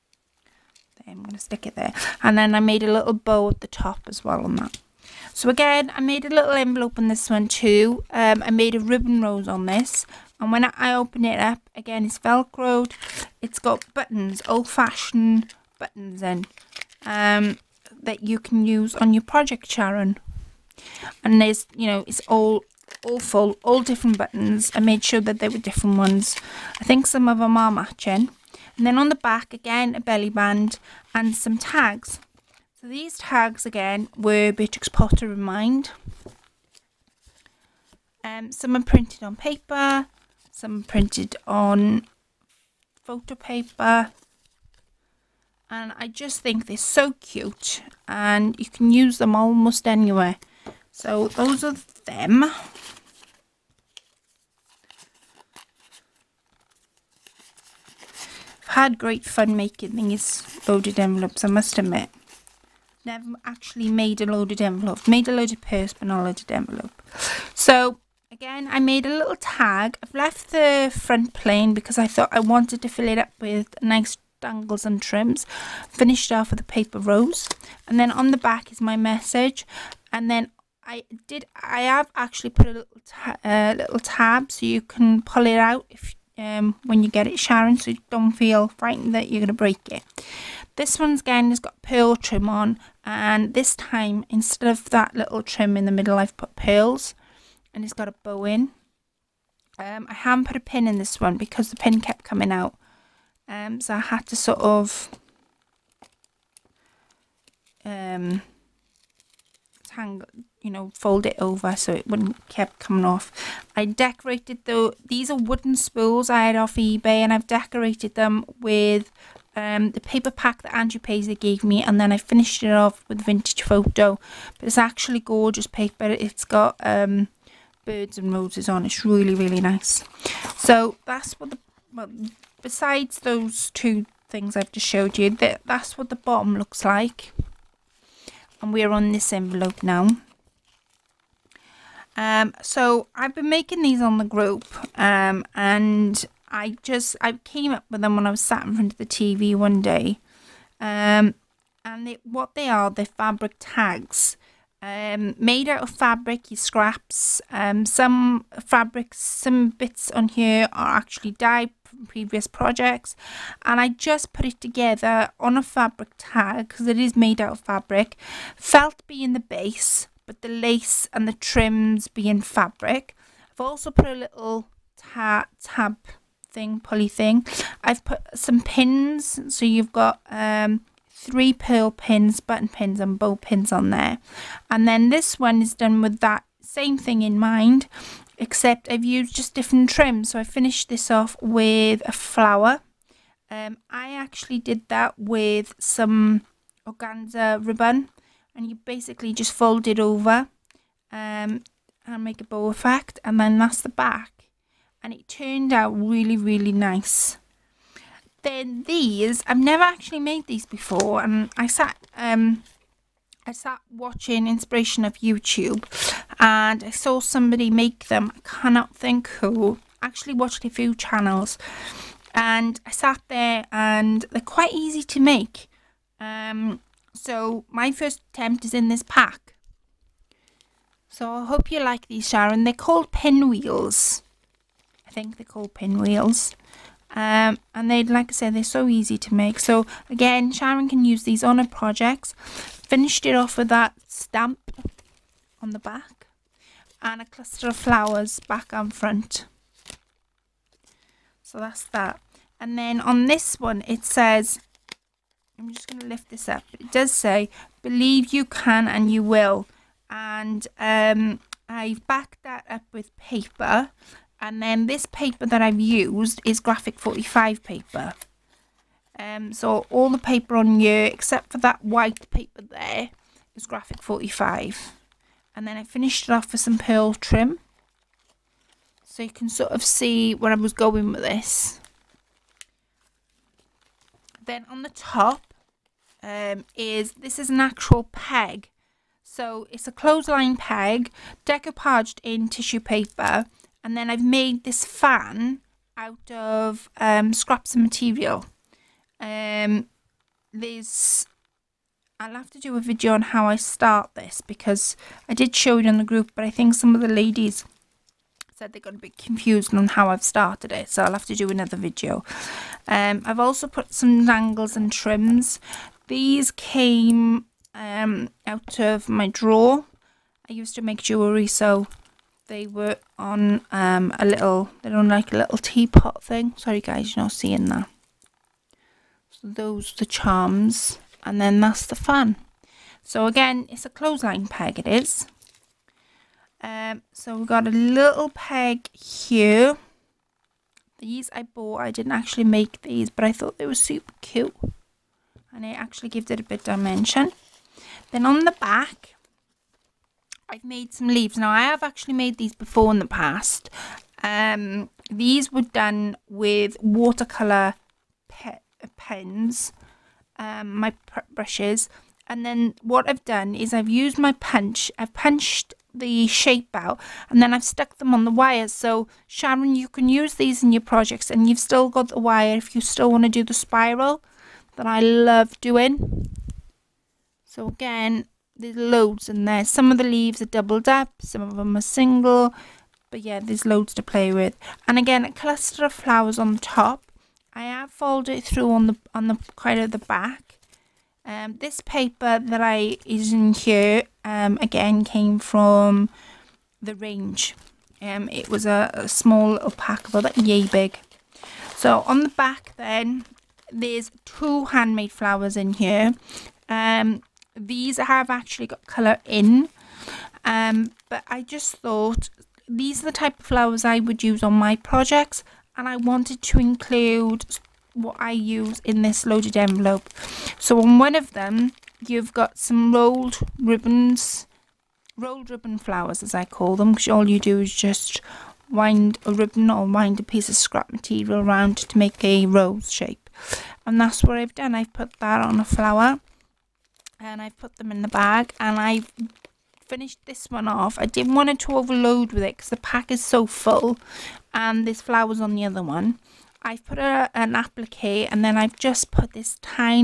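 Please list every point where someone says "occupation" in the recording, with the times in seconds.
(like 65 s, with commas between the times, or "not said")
not said.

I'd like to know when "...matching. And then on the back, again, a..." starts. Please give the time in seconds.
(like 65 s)
27 s.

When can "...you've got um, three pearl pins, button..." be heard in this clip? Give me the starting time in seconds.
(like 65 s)
179 s.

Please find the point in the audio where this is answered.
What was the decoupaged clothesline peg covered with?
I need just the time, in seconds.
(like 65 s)
292 s.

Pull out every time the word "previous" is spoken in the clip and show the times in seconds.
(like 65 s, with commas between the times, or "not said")
162 s.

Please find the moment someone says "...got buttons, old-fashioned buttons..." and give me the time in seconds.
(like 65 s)
13 s.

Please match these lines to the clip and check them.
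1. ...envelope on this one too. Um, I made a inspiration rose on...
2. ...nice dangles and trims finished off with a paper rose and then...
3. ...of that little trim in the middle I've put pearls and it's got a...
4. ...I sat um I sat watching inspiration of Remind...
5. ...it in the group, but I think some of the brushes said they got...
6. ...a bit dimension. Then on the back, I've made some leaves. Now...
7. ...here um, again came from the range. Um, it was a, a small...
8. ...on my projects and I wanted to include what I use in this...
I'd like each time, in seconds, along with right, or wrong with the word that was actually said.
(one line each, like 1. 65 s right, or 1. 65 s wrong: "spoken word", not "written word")
1. 6 s wrong: "ribbon", not "inspiration"
2. 73 s right
3. 94 s right
4. 211 s wrong: "YouTube", not "Remind"
5. 305 s wrong: "ladies", not "brushes"
6. 346 s right
7. 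393 s right
8. 414 s right.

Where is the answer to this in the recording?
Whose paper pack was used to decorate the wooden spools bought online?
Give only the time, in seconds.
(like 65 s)
120 s.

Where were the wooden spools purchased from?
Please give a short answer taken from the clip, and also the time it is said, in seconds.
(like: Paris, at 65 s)
eBay, at 116 s.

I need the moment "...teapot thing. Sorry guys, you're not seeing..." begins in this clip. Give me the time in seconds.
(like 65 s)
325 s.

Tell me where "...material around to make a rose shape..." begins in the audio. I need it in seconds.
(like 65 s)
430 s.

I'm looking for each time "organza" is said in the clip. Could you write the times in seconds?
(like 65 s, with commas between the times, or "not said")
196 s.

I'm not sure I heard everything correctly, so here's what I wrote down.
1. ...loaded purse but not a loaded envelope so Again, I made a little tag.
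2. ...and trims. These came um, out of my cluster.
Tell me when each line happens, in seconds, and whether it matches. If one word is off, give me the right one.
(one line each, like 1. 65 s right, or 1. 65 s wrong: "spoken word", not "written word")
1. 65 s right
2. 314 s wrong: "drawer", not "cluster".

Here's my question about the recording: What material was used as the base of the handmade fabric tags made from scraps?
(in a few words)
Felt.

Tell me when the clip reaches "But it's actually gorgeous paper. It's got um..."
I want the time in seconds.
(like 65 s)
124 s.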